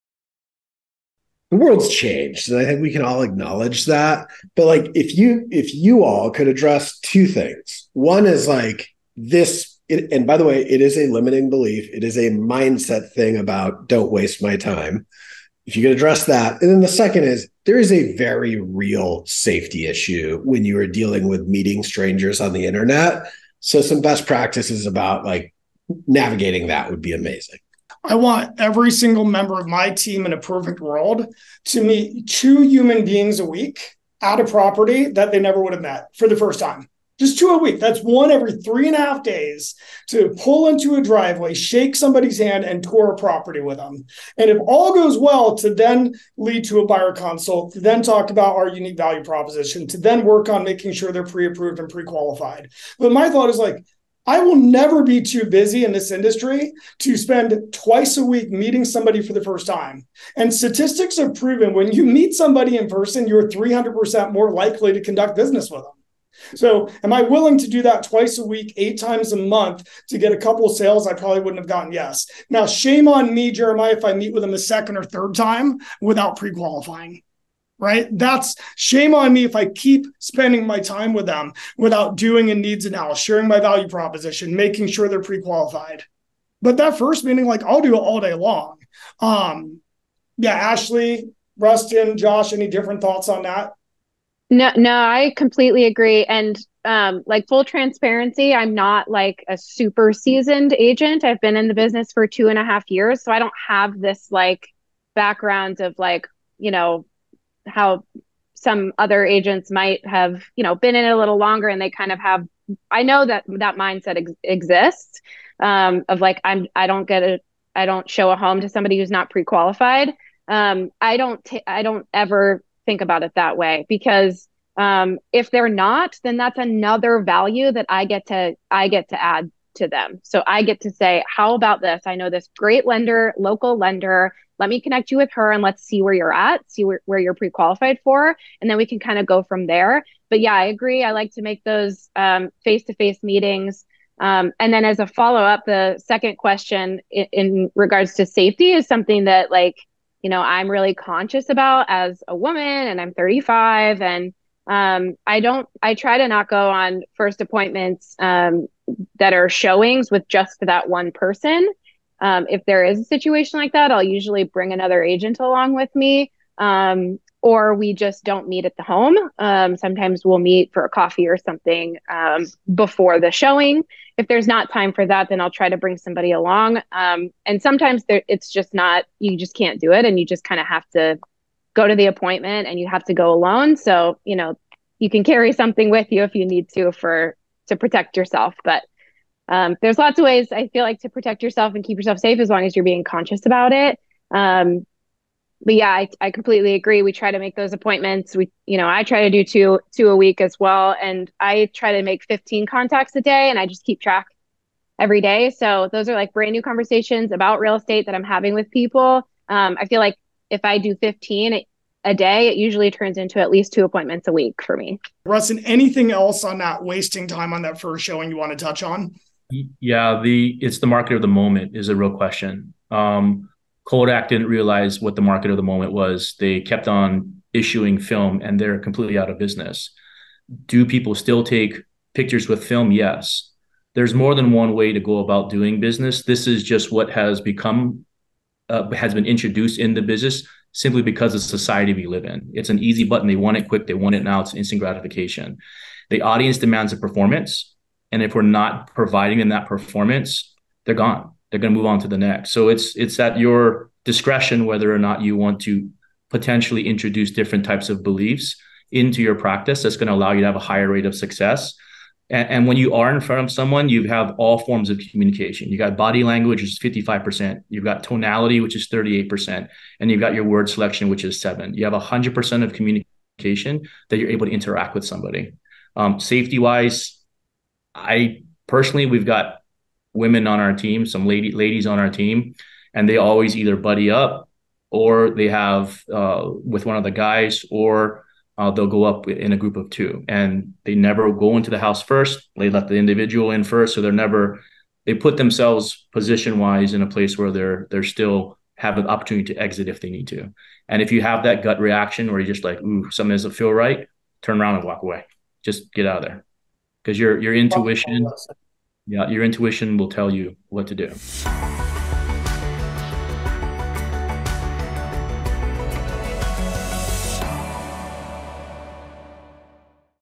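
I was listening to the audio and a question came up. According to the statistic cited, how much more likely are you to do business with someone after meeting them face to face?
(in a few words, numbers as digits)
300%.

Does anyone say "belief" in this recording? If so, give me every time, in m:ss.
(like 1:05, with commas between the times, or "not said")
0:11, 4:18.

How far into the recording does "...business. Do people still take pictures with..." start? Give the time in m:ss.
3:49.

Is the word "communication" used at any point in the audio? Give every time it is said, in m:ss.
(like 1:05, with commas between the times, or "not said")
4:25, 4:32.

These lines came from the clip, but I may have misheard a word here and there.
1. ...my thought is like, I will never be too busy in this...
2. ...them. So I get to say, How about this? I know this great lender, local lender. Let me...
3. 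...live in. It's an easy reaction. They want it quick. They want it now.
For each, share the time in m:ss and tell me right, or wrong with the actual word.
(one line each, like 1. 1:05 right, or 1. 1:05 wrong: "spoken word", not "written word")
1. 0:53 right
2. 2:09 right
3. 4:02 wrong: "button", not "reaction".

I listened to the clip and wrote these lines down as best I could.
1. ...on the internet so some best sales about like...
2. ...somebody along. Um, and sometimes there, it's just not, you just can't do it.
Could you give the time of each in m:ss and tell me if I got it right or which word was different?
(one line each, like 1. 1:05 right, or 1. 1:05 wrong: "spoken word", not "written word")
1. 0:22 wrong: "practices", not "sales"
2. 2:55 right.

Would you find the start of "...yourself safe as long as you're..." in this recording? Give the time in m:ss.
3:11.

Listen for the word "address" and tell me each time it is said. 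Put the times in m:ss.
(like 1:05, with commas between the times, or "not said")
0:06, 0:15.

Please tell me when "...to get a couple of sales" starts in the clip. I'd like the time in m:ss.
1:10.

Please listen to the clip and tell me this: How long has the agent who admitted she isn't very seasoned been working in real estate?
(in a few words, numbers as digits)
2.5 years.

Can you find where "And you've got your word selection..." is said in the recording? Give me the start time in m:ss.
4:29.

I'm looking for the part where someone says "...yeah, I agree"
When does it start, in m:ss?
2:20.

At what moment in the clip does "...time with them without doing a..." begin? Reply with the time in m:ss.
1:20.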